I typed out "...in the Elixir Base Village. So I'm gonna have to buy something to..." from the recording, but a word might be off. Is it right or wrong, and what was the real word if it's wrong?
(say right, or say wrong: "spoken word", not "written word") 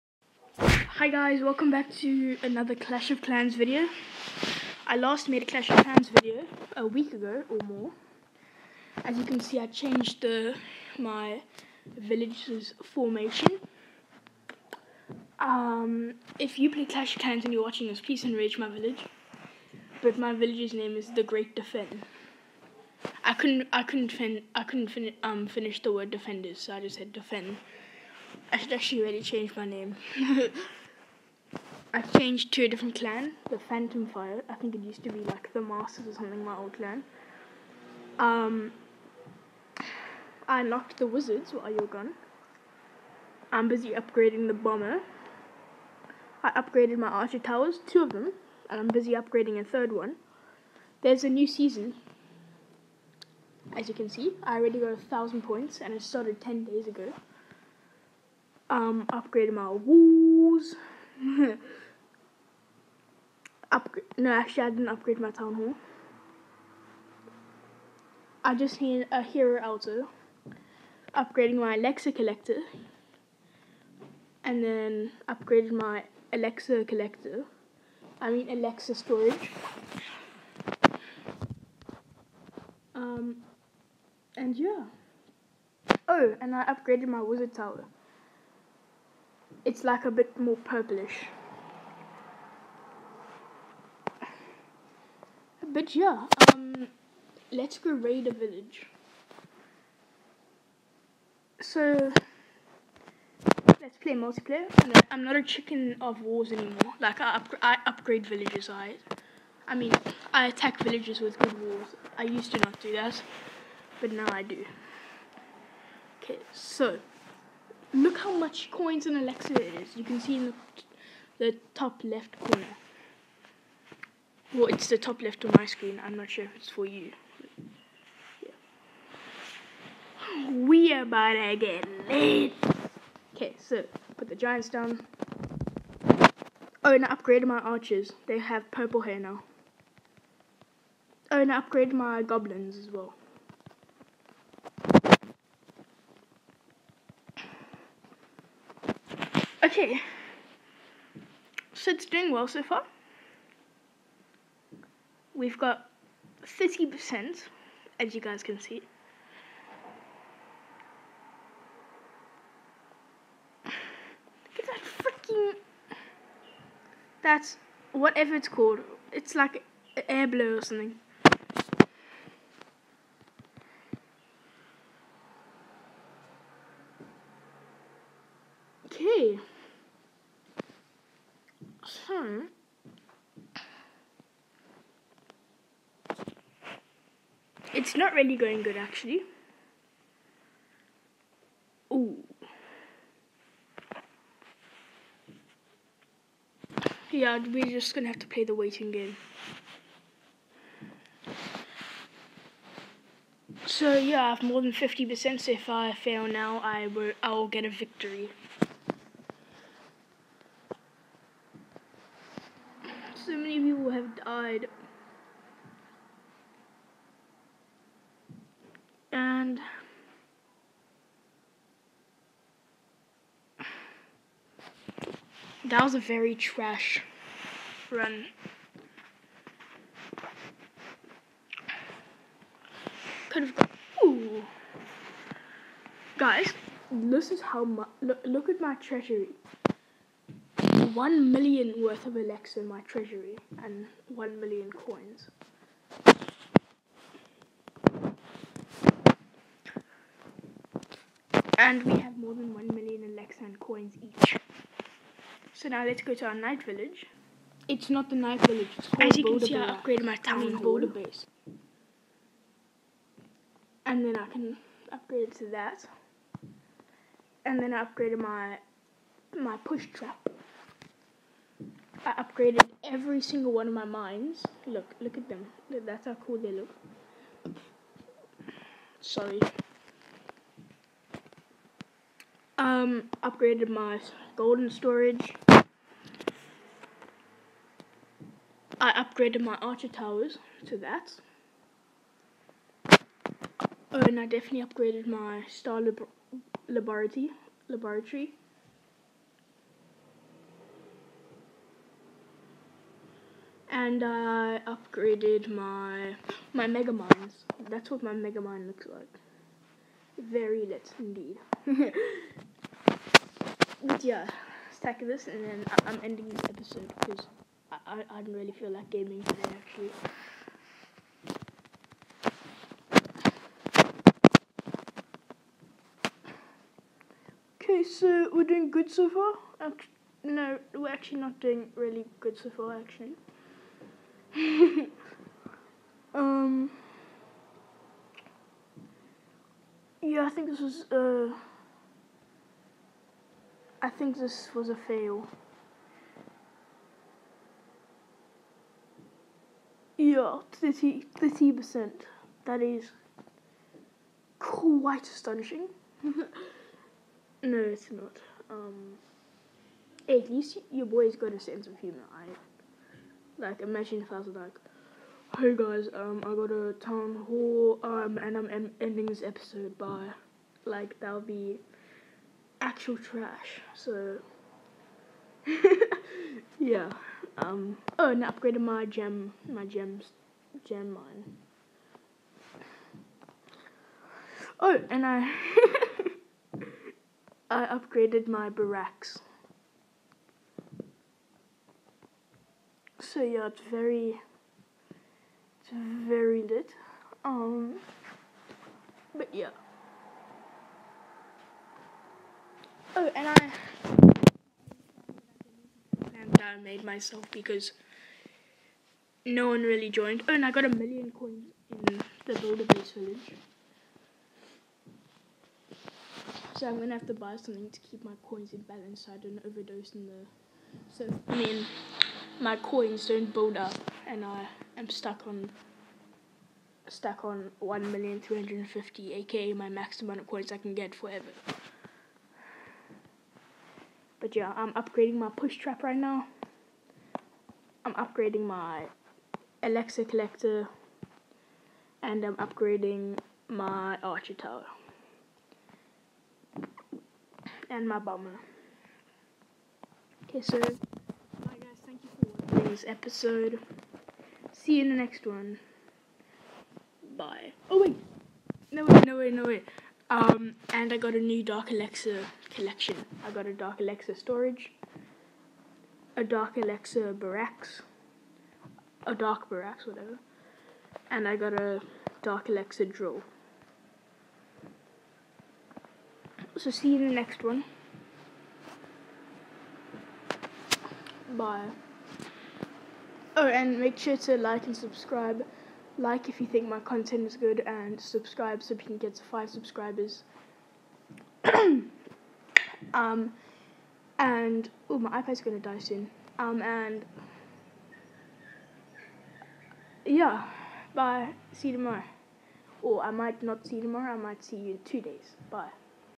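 wrong: "Builder", not "Elixir".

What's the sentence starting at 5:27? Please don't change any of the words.
Okay, so we're doing good so far.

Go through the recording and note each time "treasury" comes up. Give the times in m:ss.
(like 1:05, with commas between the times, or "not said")
3:58, 4:02.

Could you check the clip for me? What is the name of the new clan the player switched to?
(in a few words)
Phantom Fire.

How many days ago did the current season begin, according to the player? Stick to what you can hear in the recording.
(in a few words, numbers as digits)
10.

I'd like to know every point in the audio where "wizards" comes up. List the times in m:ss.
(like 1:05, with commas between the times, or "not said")
0:41, 1:27.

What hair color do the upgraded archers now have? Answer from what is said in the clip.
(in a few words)
Purple.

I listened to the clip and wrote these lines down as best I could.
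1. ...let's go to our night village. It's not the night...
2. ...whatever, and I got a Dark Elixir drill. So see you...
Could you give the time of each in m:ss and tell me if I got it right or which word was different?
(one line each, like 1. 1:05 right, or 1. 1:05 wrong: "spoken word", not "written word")
1. 4:15 right
2. 7:49 right.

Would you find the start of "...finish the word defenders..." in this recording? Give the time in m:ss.
0:25.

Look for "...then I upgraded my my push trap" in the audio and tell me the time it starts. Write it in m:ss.
4:27.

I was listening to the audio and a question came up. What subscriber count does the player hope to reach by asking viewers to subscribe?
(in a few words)
5.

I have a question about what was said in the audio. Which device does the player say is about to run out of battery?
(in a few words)
iPad.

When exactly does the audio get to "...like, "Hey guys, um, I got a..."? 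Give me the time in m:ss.
6:04.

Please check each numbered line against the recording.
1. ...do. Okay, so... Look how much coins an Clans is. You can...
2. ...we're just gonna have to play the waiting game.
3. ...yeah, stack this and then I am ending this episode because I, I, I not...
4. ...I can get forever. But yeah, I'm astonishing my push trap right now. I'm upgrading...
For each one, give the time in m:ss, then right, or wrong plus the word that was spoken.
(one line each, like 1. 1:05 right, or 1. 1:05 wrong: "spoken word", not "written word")
1. 1:54 wrong: "Elixir", not "Clans"
2. 3:17 right
3. 5:14 right
4. 7:10 wrong: "upgrading", not "astonishing".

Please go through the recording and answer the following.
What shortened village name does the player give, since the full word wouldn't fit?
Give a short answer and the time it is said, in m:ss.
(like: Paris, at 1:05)
The Great Defend, at 0:21.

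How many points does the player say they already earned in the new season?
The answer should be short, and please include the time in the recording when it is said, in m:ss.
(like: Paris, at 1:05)
1,000, at 0:54.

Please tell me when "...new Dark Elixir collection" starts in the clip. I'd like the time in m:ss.
7:41.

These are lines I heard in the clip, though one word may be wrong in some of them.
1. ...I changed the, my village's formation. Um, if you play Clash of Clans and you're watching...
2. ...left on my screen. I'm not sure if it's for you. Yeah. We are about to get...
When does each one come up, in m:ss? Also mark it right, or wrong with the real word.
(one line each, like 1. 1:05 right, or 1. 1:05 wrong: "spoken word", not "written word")
1. 0:09 right
2. 2:05 right.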